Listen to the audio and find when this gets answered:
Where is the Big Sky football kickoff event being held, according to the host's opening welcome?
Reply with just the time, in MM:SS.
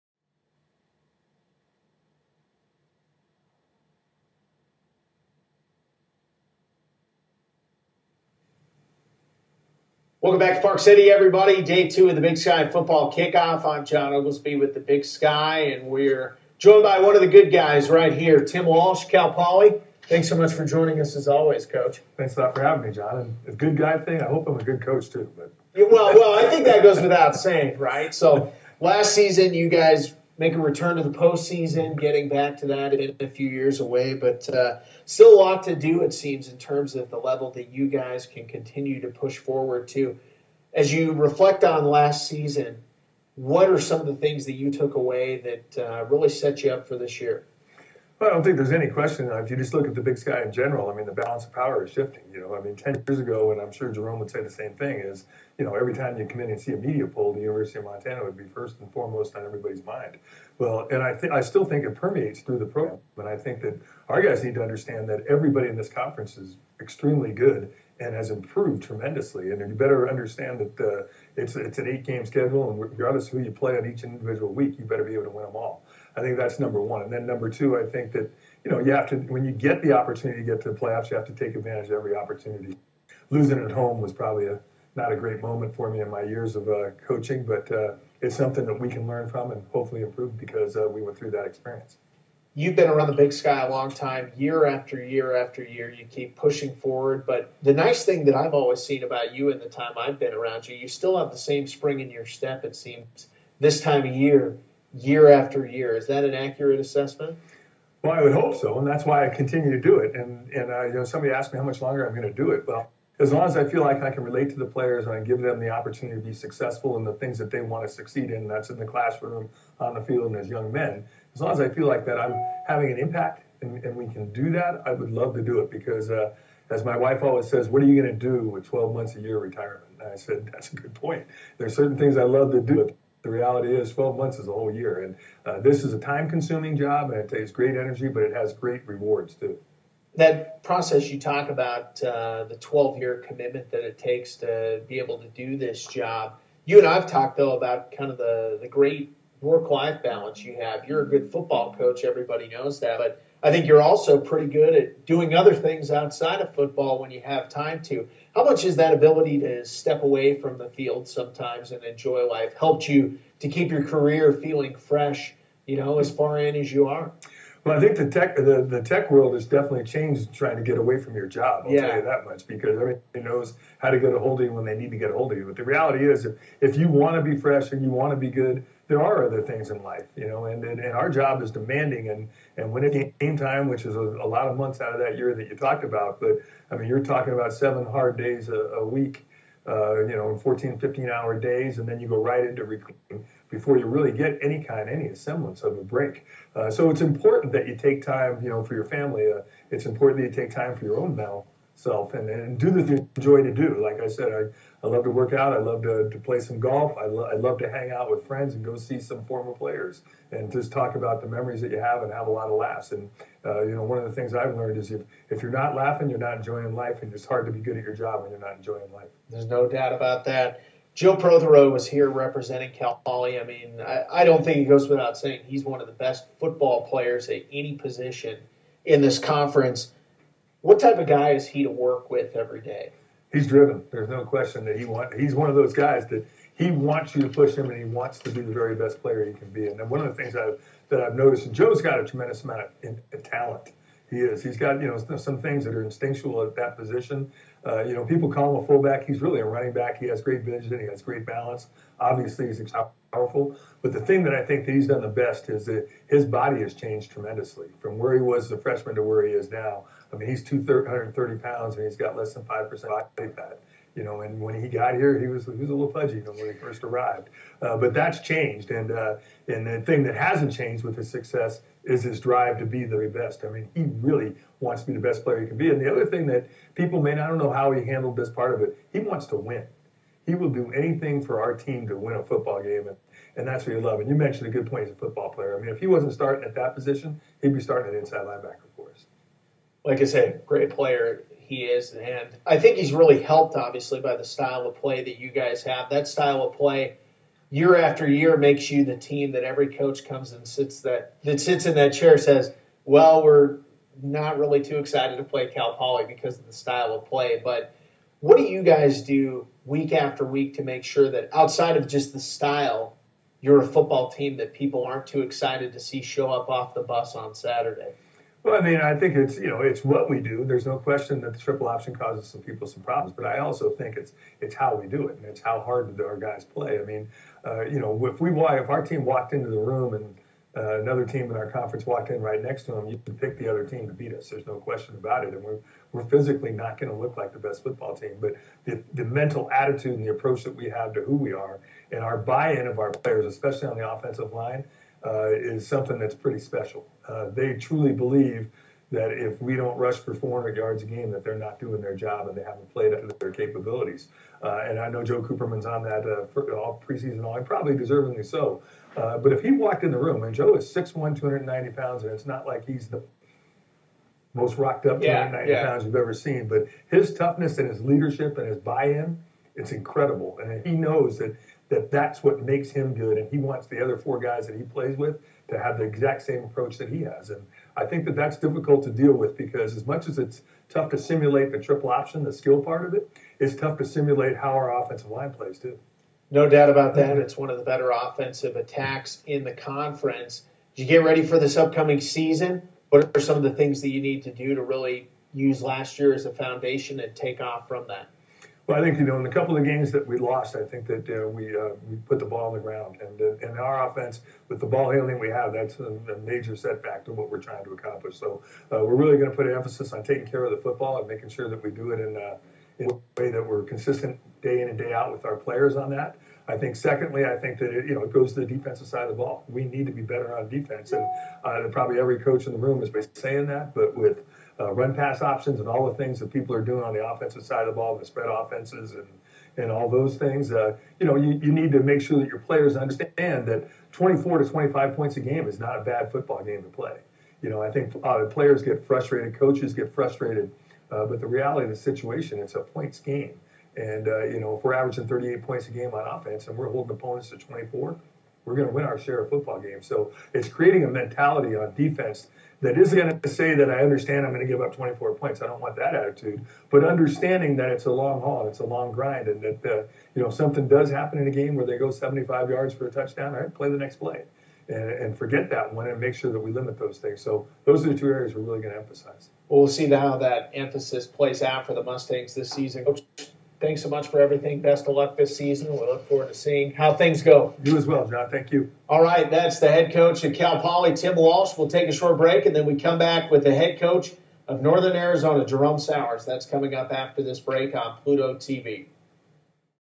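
00:10.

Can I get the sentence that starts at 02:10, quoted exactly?
And I said, that's a good point.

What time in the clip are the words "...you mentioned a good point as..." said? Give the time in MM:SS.
04:44.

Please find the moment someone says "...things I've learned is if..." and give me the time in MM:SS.
03:34.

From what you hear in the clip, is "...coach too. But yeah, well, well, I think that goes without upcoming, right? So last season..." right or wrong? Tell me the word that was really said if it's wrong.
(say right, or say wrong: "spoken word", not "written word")
wrong: "saying", not "upcoming".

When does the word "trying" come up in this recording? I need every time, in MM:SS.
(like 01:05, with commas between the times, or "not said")
02:50, 06:47.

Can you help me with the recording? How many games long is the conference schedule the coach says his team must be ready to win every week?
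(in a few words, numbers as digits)
8.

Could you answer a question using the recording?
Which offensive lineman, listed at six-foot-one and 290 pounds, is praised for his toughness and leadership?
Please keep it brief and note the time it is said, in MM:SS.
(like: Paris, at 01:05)
Joe Cooperman, at 05:55.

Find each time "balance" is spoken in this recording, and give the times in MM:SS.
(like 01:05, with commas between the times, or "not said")
00:51, 02:30, 04:11.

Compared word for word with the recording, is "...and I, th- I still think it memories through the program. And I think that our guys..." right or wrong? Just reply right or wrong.
wrong.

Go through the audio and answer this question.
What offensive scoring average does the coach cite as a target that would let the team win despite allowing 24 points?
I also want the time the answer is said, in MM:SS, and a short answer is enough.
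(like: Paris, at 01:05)
38 points, at 07:25.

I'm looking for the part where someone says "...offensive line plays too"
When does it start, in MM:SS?
06:24.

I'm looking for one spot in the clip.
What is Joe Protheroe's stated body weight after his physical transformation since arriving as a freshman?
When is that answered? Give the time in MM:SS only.
04:20.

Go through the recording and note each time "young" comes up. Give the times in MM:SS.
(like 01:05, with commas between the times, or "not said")
02:00.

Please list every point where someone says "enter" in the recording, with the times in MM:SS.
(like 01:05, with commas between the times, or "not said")
not said.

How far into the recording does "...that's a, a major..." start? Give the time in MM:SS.
06:45.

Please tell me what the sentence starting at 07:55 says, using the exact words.
We look forward to seeing how things go.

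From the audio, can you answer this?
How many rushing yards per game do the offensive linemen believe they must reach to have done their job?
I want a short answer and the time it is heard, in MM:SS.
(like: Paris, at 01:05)
400, at 05:50.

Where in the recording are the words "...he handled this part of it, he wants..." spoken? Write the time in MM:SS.
04:37.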